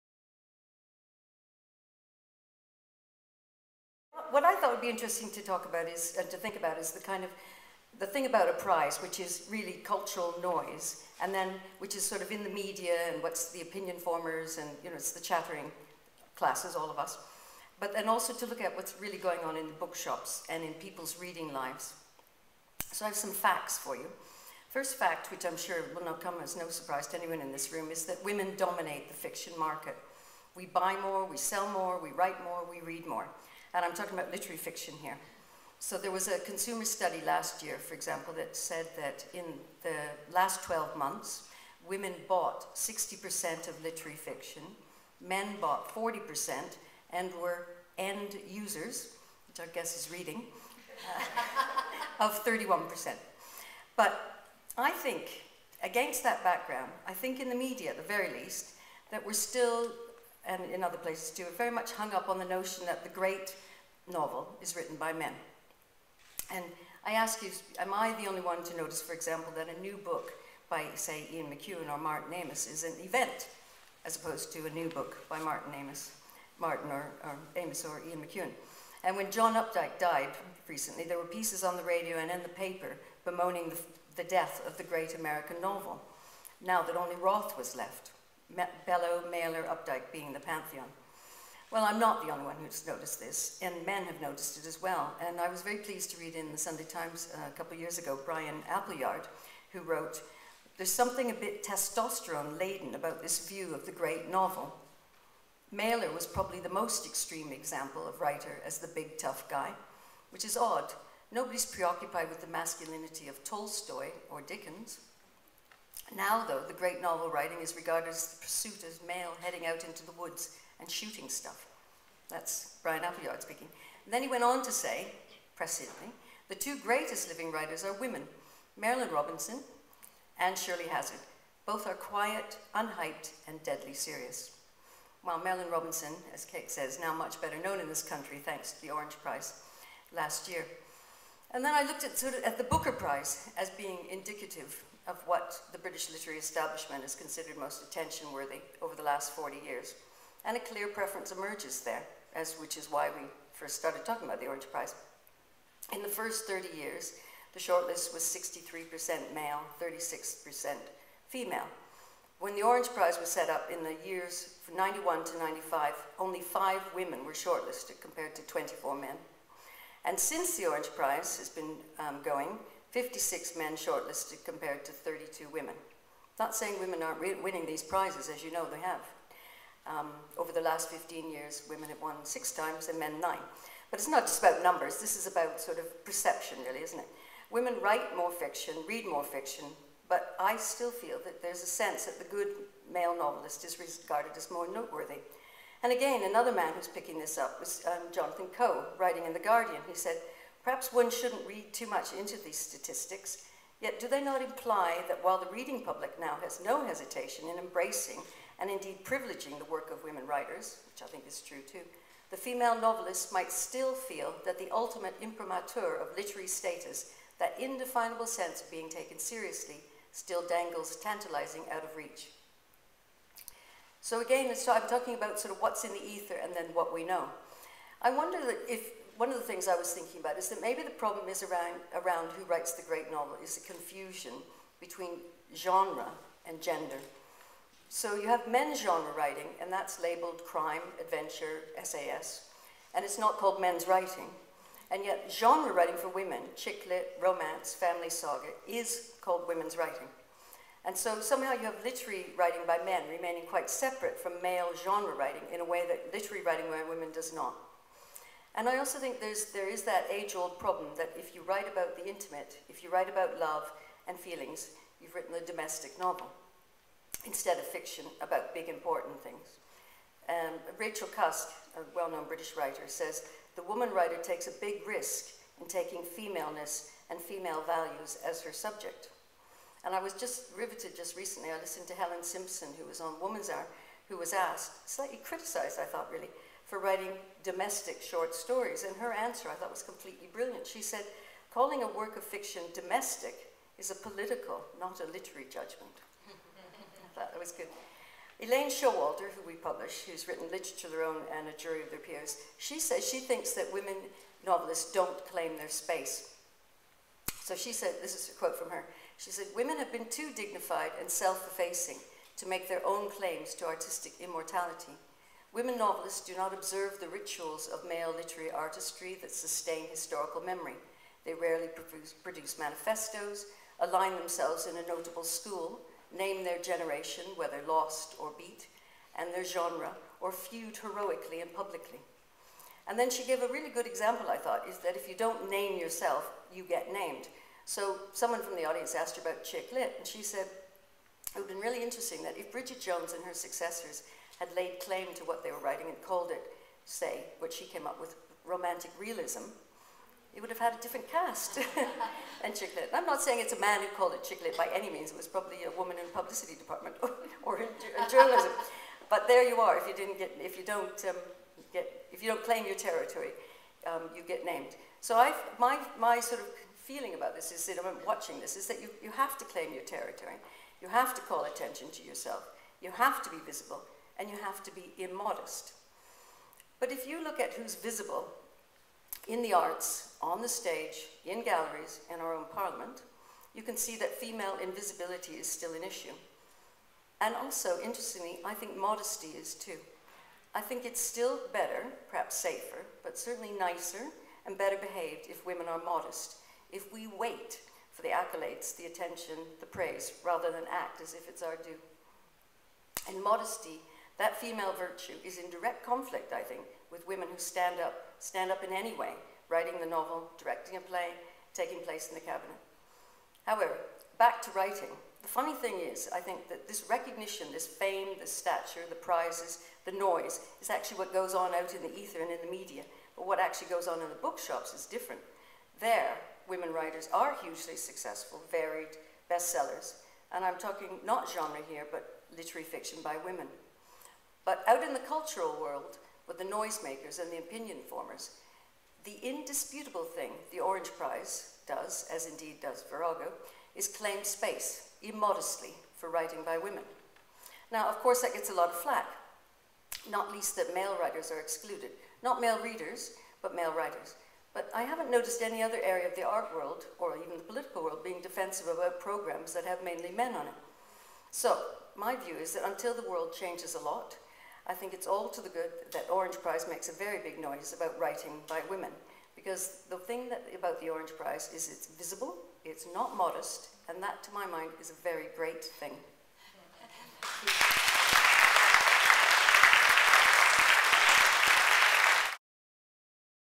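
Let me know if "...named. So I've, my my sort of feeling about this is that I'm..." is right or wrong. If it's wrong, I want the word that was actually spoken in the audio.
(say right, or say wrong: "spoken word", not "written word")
right.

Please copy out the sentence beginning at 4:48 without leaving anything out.
And her answer I thought was completely brilliant.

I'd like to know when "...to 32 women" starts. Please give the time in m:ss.
2:54.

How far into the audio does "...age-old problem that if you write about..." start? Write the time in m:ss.
4:20.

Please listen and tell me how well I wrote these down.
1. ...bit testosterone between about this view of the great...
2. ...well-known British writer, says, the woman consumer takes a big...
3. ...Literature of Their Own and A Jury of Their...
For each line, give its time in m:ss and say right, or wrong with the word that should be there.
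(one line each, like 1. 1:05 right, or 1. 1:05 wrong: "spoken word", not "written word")
1. 1:41 wrong: "laden", not "between"
2. 4:31 wrong: "writer", not "consumer"
3. 5:00 right.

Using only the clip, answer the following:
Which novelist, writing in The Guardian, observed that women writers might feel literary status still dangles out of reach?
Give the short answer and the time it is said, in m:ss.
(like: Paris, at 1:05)
Jonathan Coe, at 3:18.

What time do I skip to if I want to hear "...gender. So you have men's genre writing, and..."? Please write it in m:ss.
3:56.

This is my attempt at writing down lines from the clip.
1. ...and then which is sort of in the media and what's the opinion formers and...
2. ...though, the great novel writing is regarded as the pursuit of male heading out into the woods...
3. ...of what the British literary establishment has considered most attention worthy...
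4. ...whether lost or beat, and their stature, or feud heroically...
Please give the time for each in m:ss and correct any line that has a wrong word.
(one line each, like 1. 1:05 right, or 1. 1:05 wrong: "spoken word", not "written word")
1. 0:11 right
2. 1:56 right
3. 2:25 right
4. 5:27 wrong: "genre", not "stature".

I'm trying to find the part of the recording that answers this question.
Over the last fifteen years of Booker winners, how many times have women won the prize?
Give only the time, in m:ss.
3:02.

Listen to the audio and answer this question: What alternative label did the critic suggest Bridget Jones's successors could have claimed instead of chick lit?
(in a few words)
Romantic realism.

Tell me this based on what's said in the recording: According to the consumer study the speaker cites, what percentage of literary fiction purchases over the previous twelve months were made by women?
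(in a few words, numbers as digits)
60%.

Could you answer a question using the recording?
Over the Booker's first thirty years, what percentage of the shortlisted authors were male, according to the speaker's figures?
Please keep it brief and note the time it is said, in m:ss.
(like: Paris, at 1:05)
63%, at 2:38.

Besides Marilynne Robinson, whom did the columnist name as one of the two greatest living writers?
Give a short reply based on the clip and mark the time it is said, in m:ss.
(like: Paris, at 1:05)
Shirley Hazzard, at 2:10.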